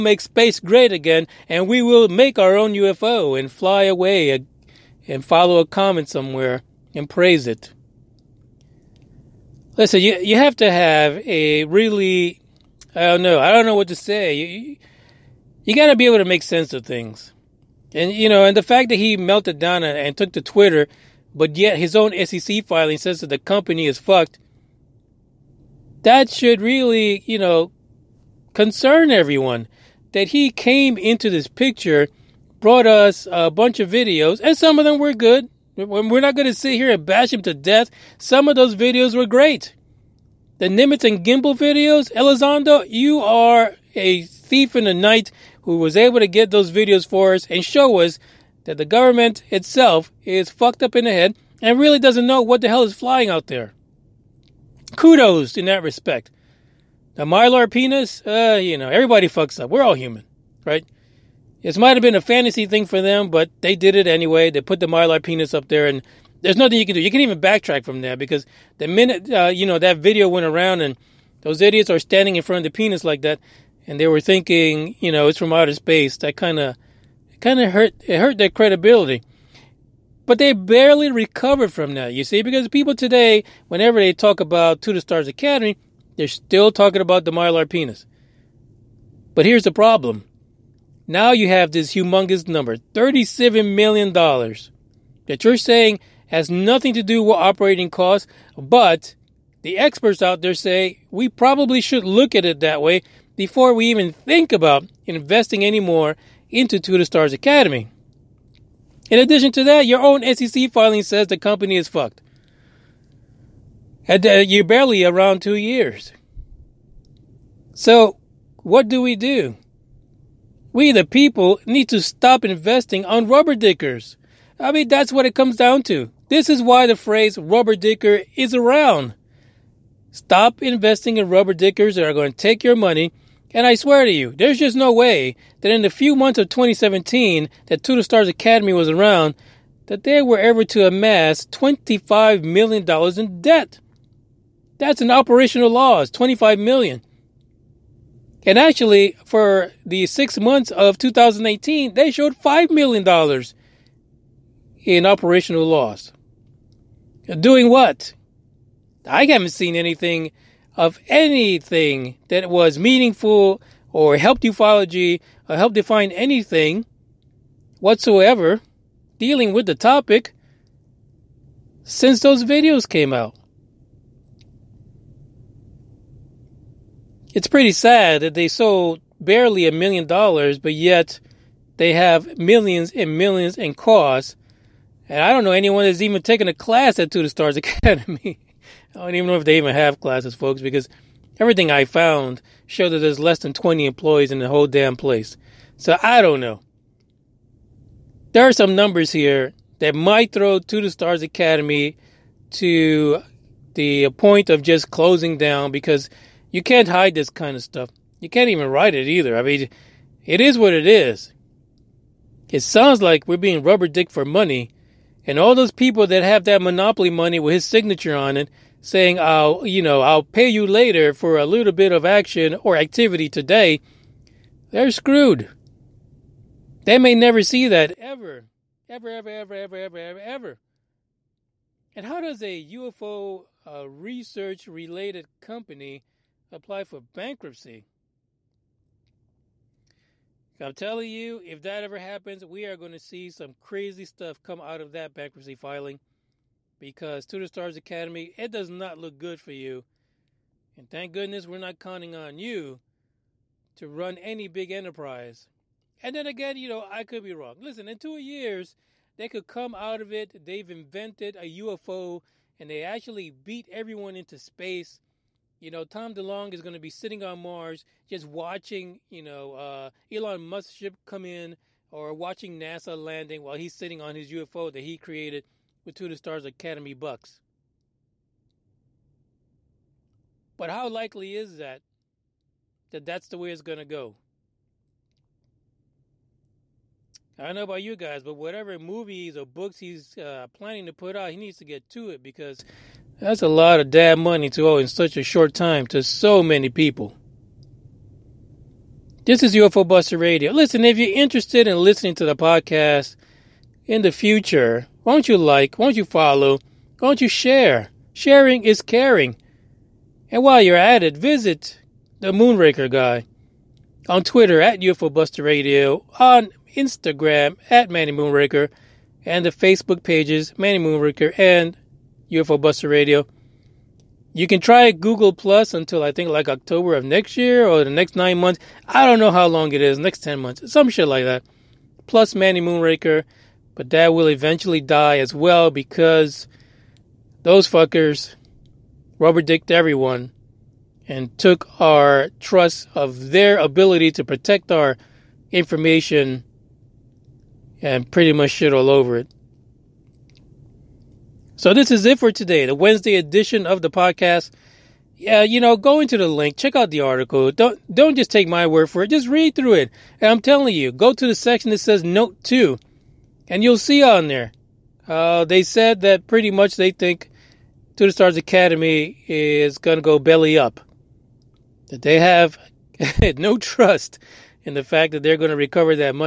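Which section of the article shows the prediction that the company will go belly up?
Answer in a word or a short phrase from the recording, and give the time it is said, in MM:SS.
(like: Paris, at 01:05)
Note 2, at 06:02.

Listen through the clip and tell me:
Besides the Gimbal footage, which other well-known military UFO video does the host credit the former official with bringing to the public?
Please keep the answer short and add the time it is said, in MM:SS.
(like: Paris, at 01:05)
Nimitz, at 00:40.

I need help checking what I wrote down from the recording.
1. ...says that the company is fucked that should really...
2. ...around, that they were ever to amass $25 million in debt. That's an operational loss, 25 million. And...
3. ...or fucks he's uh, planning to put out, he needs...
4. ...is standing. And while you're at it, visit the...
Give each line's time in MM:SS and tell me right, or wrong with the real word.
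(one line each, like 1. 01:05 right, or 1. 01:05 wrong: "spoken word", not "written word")
1. 00:22 right
2. 02:18 right
3. 04:49 wrong: "books", not "fucks"
4. 05:08 wrong: "caring", not "standing".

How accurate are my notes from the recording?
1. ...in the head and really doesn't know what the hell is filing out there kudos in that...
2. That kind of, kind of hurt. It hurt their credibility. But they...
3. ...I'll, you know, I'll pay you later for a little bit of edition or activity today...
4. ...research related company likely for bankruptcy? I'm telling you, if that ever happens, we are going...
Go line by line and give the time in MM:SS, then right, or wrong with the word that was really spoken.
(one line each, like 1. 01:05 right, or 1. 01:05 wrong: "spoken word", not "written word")
1. 00:50 wrong: "flying", not "filing"
2. 01:16 right
3. 03:39 wrong: "action", not "edition"
4. 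03:53 wrong: "apply", not "likely".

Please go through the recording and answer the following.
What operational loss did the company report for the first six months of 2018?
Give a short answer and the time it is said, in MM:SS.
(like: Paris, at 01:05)
$5 million, at 02:32.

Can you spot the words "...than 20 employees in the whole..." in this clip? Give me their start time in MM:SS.
03:13.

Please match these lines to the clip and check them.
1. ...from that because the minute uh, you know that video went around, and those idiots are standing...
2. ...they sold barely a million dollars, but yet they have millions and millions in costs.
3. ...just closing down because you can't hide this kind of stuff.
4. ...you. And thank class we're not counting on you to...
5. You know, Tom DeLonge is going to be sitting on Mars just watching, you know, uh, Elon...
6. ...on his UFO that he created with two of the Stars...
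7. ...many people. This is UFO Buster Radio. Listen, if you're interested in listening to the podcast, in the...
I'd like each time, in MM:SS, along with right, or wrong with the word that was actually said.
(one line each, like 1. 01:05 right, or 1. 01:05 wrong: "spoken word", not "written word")
1. 01:07 right
2. 02:58 right
3. 03:24 right
4. 04:09 wrong: "goodness", not "class"
5. 04:25 right
6. 04:34 right
7. 04:56 right.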